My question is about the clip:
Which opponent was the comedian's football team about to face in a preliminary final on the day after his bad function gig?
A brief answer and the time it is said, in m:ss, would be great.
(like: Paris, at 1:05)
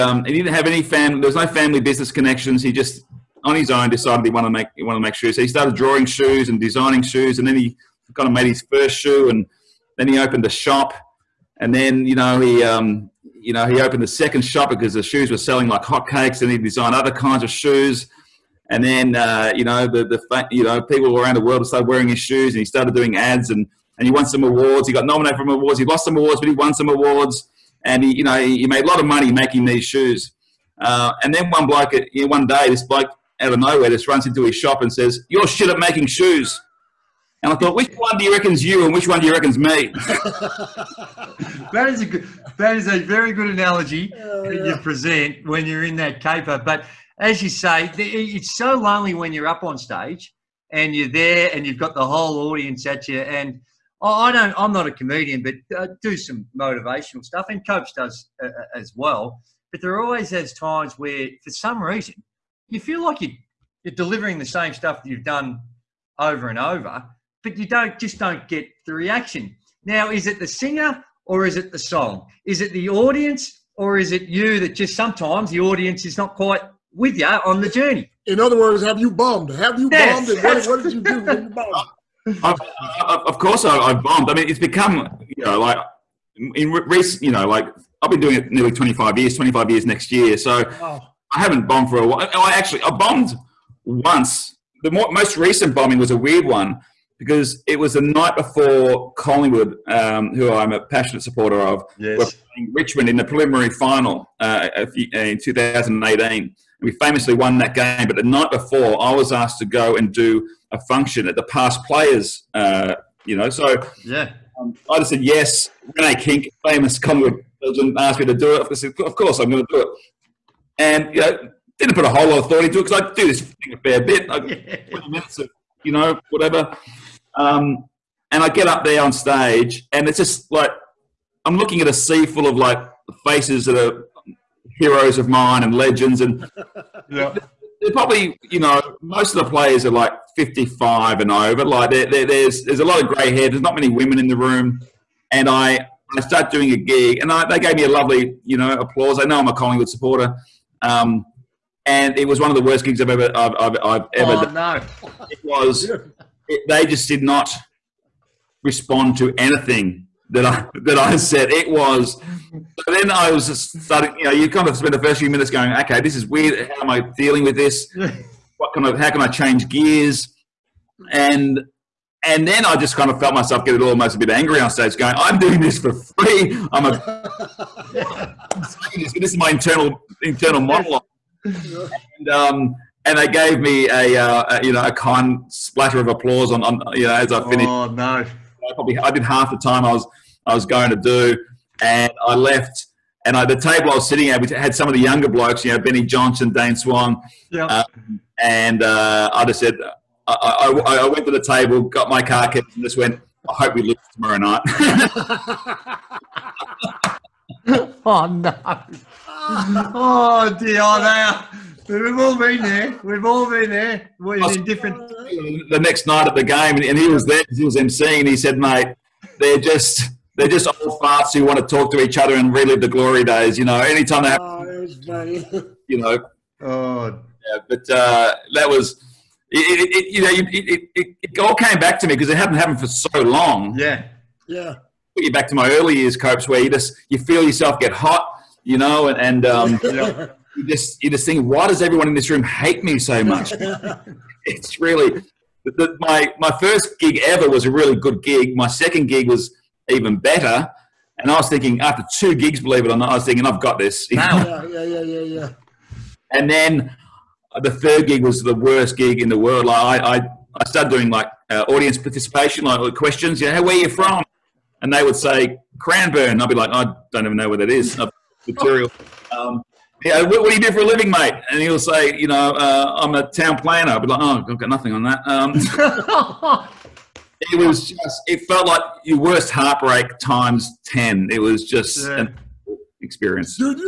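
Richmond, at 1:42.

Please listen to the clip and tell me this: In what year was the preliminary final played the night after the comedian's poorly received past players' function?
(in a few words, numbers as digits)
2018.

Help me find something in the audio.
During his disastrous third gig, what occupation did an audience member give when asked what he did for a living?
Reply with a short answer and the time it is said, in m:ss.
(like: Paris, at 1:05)
Town planner, at 4:33.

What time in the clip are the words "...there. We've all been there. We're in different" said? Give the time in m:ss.
3:32.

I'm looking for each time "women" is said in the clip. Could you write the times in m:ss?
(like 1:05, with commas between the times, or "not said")
2:23.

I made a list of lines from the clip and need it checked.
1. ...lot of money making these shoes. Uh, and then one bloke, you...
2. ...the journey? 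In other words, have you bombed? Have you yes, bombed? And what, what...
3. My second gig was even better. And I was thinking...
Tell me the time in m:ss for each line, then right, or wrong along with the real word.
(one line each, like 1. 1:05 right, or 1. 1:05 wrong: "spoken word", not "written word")
1. 0:28 right
2. 1:17 right
3. 4:08 right.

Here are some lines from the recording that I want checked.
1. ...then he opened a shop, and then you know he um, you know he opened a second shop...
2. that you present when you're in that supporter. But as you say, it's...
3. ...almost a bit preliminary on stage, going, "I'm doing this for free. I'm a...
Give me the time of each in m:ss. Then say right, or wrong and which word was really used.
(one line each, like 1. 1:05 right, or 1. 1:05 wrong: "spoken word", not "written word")
1. 0:09 right
2. 0:44 wrong: "caper", not "supporter"
3. 2:53 wrong: "angry", not "preliminary".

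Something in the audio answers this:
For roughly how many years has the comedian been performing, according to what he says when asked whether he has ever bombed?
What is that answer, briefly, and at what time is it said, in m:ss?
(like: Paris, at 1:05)
25, at 1:28.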